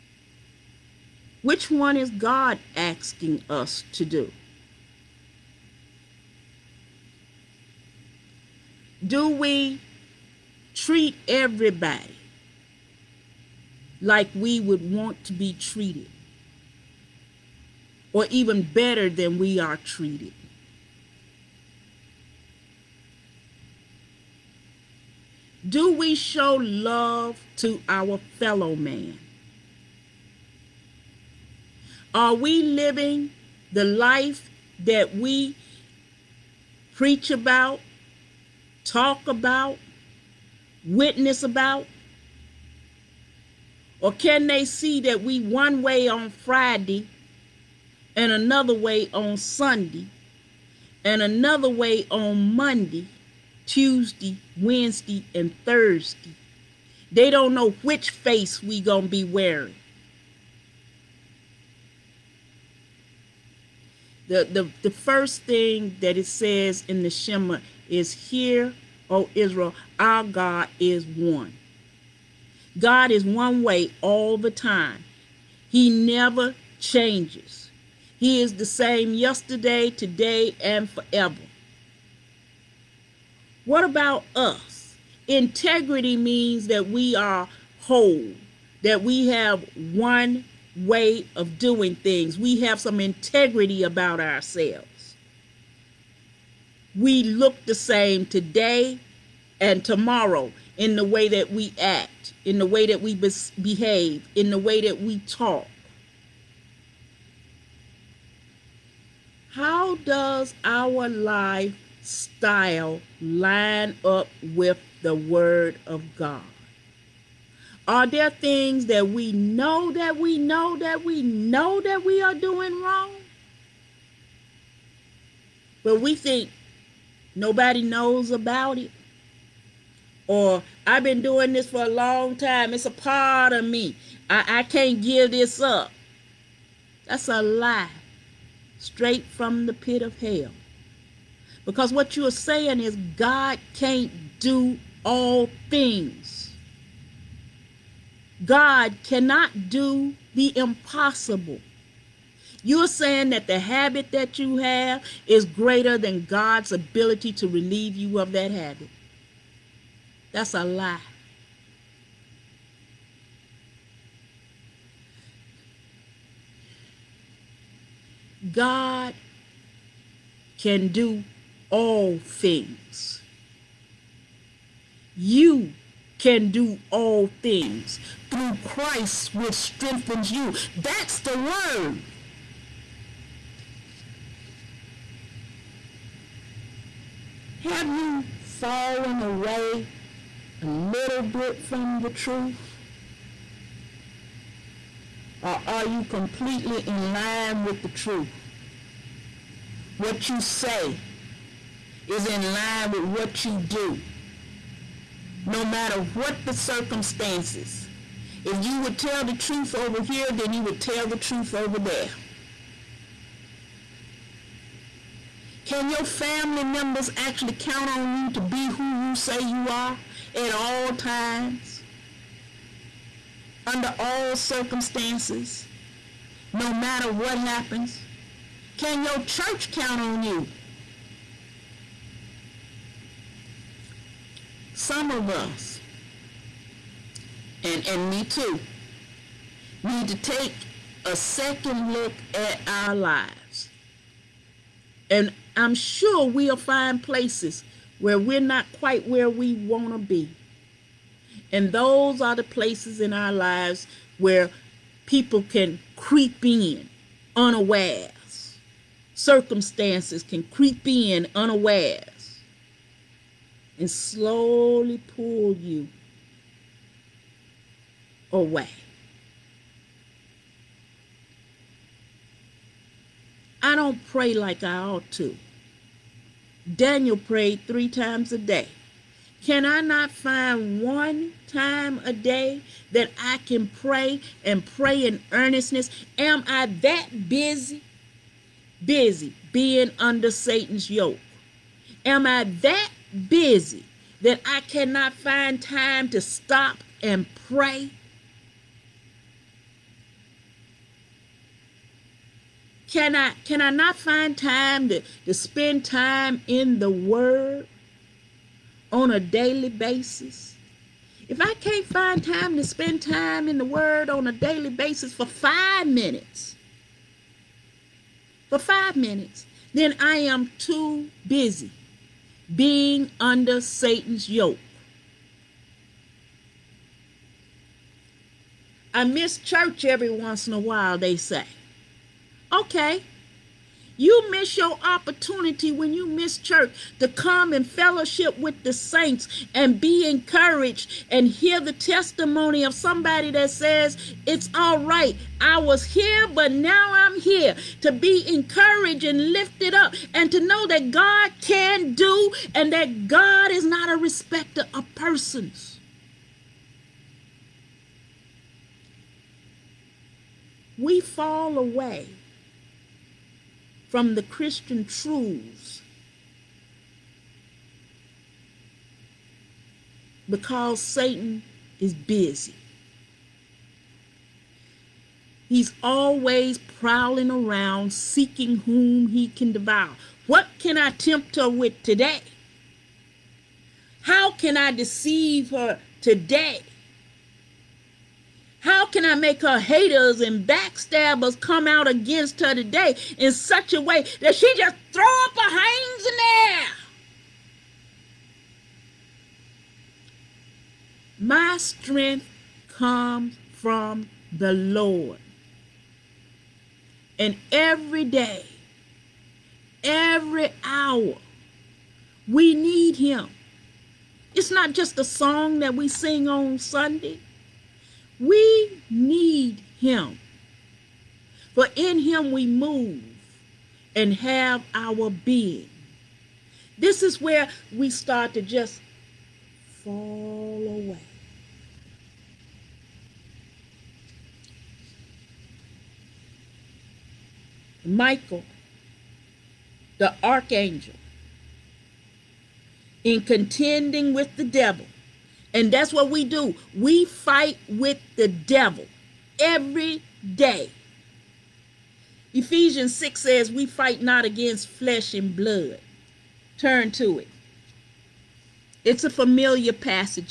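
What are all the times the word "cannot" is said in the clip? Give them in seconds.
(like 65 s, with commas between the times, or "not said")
149 s, 294 s.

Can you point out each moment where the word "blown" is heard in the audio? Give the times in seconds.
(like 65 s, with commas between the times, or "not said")
not said.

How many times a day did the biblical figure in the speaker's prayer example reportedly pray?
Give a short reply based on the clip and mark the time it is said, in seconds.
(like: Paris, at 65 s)
3, at 277 s.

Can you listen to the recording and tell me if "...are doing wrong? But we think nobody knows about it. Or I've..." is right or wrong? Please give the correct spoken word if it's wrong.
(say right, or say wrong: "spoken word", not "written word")
right.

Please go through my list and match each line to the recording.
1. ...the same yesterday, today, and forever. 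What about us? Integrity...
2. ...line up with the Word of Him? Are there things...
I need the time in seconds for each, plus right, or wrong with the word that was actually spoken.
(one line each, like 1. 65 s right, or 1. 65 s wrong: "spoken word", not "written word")
1. 78 s right
2. 113 s wrong: "God", not "Him".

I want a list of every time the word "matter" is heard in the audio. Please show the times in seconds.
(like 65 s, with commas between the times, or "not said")
205 s, 226 s.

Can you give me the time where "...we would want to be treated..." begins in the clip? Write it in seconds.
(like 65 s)
14 s.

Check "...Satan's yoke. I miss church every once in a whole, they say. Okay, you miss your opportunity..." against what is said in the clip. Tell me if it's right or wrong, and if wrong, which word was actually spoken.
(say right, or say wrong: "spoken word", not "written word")
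wrong: "while", not "whole".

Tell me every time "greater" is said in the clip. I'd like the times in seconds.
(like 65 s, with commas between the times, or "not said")
155 s.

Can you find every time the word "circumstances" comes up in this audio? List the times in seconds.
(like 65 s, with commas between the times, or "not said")
206 s, 224 s, 259 s.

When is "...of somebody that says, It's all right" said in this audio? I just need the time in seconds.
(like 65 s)
342 s.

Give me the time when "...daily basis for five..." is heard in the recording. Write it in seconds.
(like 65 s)
314 s.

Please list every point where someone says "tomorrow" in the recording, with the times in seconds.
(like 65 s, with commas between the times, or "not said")
99 s.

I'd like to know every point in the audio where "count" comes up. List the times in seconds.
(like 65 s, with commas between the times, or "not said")
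217 s, 229 s.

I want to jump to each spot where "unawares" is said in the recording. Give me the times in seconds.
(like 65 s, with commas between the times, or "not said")
257 s, 261 s.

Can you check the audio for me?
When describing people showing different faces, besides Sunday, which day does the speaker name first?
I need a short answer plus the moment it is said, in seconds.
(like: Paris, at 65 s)
Friday, at 46 s.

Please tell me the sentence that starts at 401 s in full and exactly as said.
My strength comes from the Lord.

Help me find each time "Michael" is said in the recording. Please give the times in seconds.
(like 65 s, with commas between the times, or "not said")
437 s.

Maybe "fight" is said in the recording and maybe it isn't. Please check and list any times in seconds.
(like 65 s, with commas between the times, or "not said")
447 s, 453 s.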